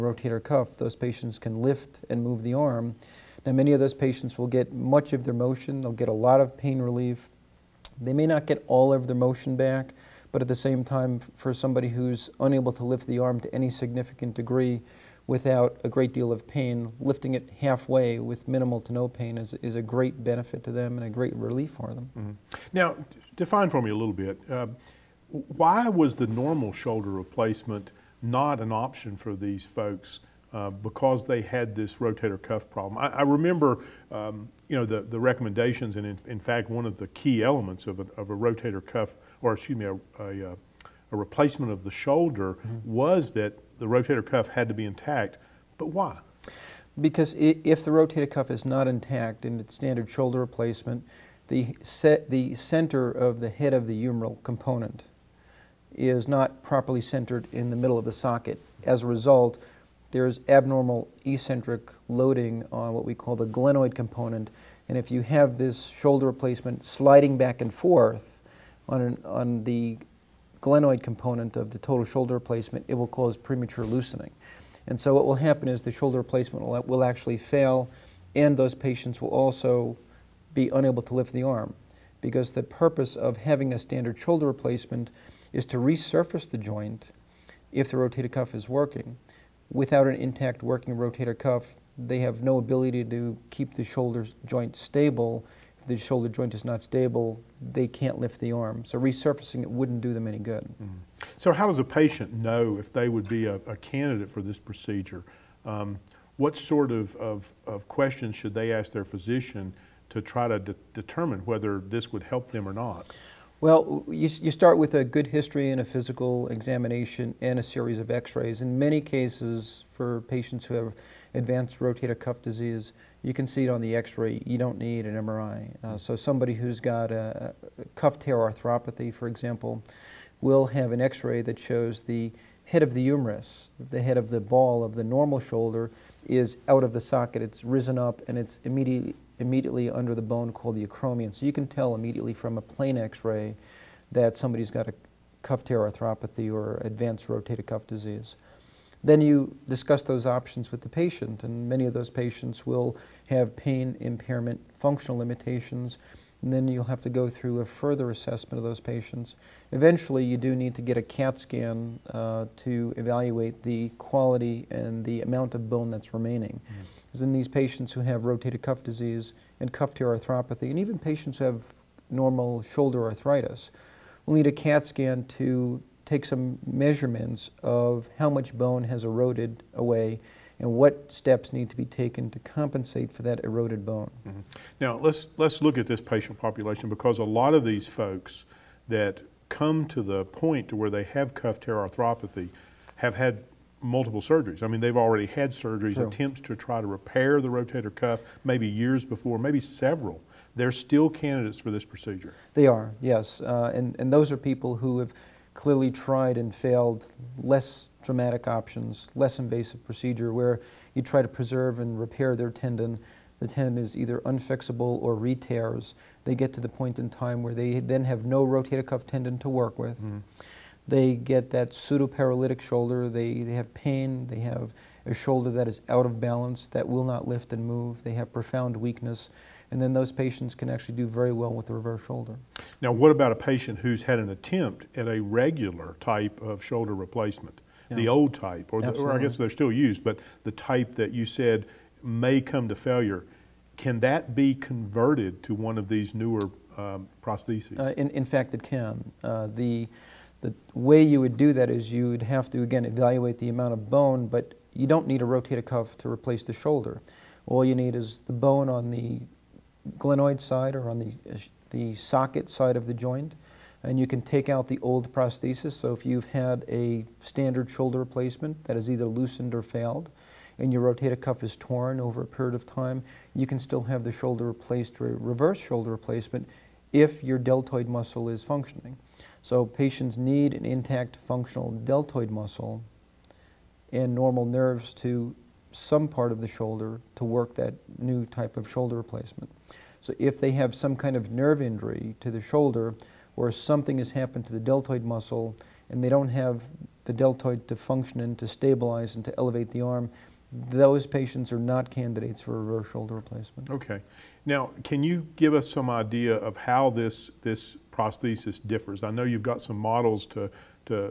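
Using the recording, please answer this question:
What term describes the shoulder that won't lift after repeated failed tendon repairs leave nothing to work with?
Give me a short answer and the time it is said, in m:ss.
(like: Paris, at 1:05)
pseudo-paralytic shoulder, at 3:41.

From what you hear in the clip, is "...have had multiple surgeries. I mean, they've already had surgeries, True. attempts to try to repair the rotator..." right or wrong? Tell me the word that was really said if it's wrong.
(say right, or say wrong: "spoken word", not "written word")
right.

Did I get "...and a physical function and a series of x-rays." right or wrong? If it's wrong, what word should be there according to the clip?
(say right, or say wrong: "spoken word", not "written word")
wrong: "examination", not "function".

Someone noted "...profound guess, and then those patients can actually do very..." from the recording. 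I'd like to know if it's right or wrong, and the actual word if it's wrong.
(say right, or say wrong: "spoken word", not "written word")
wrong: "weakness", not "guess".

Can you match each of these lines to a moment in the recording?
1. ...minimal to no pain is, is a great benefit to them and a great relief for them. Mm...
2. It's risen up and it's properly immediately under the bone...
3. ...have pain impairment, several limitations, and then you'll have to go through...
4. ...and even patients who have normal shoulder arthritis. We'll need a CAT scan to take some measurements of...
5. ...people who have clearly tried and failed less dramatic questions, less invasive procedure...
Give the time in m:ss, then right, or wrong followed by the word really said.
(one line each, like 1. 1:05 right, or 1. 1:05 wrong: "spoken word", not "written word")
1. 0:18 right
2. 2:17 wrong: "immediately", not "properly"
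3. 2:33 wrong: "functional", not "several"
4. 2:50 right
5. 3:24 wrong: "options", not "questions".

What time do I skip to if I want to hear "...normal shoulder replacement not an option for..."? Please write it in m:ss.
0:26.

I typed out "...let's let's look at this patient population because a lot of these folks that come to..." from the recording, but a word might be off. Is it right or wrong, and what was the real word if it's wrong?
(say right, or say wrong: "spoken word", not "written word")
right.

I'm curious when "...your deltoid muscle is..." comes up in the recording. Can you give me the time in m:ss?
4:37.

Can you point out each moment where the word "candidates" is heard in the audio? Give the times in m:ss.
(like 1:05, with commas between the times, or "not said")
1:43, 3:21, 5:01.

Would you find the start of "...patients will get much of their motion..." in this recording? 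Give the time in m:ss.
0:03.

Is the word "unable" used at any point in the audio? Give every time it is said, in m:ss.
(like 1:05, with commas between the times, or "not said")
0:12, 1:20.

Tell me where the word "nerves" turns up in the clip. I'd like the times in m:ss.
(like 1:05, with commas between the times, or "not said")
4:44, 4:51.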